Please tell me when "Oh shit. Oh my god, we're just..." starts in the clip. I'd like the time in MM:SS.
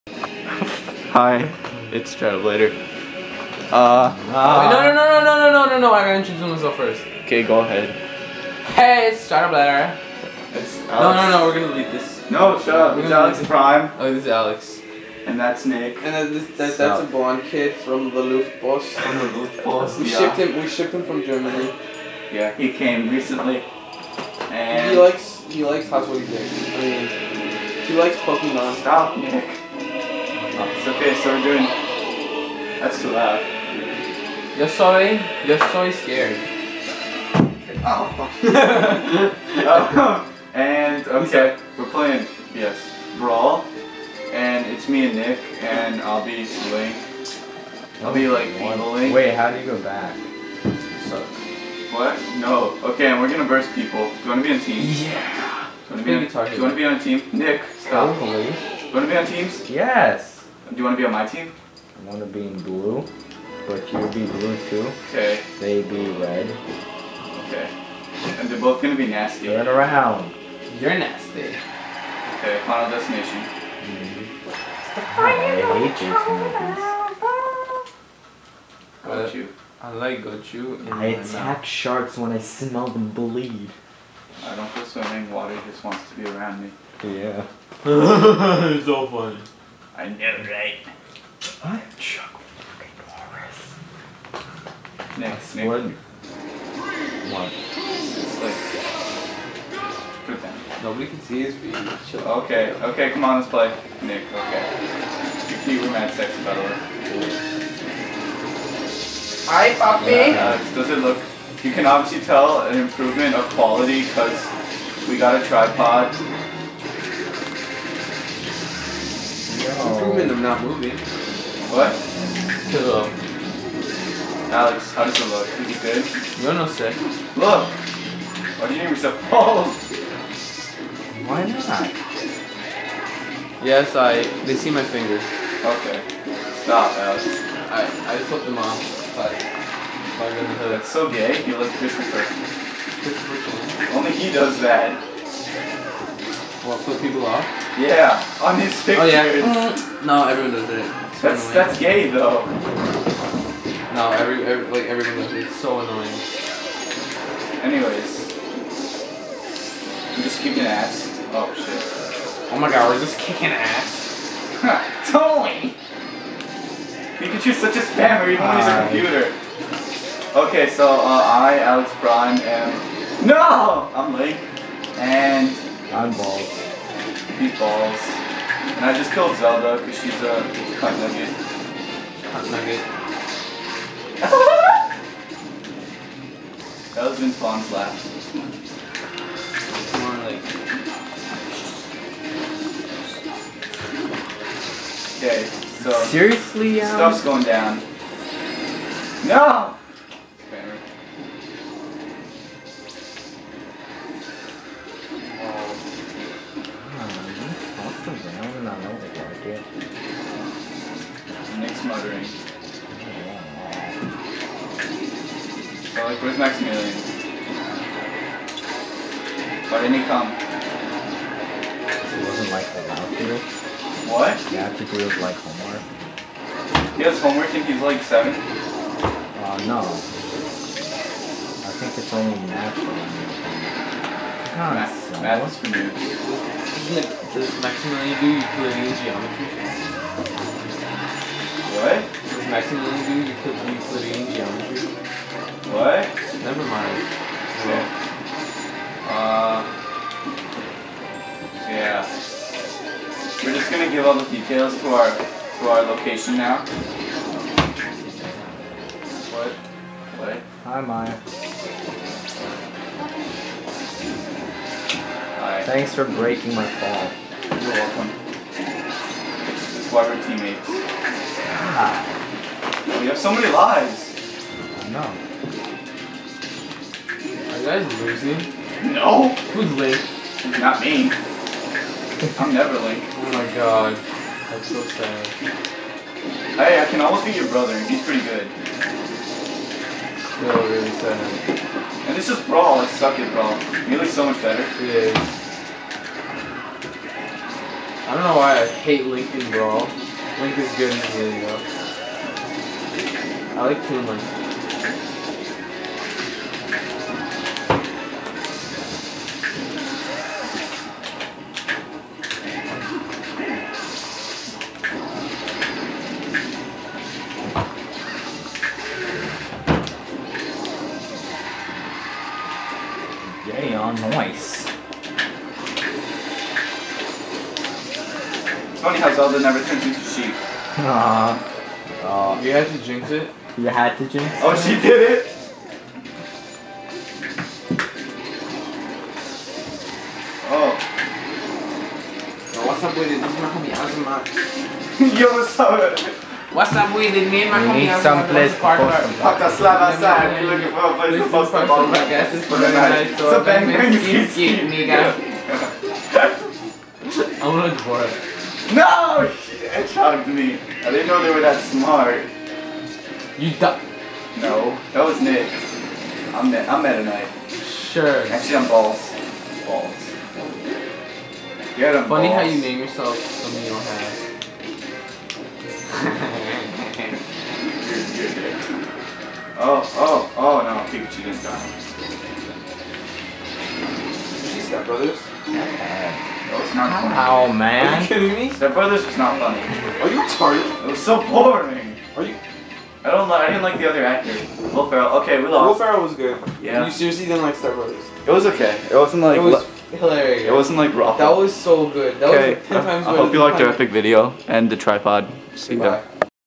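02:41.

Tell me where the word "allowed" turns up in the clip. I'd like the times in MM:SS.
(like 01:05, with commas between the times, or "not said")
03:42.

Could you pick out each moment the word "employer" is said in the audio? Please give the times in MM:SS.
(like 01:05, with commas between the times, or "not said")
not said.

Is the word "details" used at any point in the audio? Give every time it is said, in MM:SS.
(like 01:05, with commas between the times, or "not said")
04:14.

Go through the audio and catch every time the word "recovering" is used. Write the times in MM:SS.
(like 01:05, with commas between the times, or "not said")
not said.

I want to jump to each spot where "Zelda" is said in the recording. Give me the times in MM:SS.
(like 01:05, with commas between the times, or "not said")
02:59, 05:29.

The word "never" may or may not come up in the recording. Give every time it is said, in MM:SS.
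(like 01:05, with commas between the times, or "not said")
04:06, 04:42, 05:29.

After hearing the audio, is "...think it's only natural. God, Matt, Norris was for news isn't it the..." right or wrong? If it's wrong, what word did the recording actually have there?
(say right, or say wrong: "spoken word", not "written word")
wrong: "Matt", not "Norris".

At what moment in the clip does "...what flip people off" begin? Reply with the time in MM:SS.
02:26.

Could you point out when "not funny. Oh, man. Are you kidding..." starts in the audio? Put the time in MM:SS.
06:25.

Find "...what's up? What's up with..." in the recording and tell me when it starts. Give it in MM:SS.
05:45.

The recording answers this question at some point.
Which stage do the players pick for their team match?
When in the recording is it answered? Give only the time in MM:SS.
01:12.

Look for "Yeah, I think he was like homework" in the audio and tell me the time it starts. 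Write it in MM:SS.
03:44.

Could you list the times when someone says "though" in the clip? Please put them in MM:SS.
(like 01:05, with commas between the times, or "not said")
02:32, 05:01.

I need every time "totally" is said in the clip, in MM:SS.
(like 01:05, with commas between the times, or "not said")
00:58, 02:45.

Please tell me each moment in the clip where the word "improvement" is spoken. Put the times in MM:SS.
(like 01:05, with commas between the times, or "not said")
01:52, 01:59.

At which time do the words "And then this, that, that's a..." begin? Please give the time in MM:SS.
00:16.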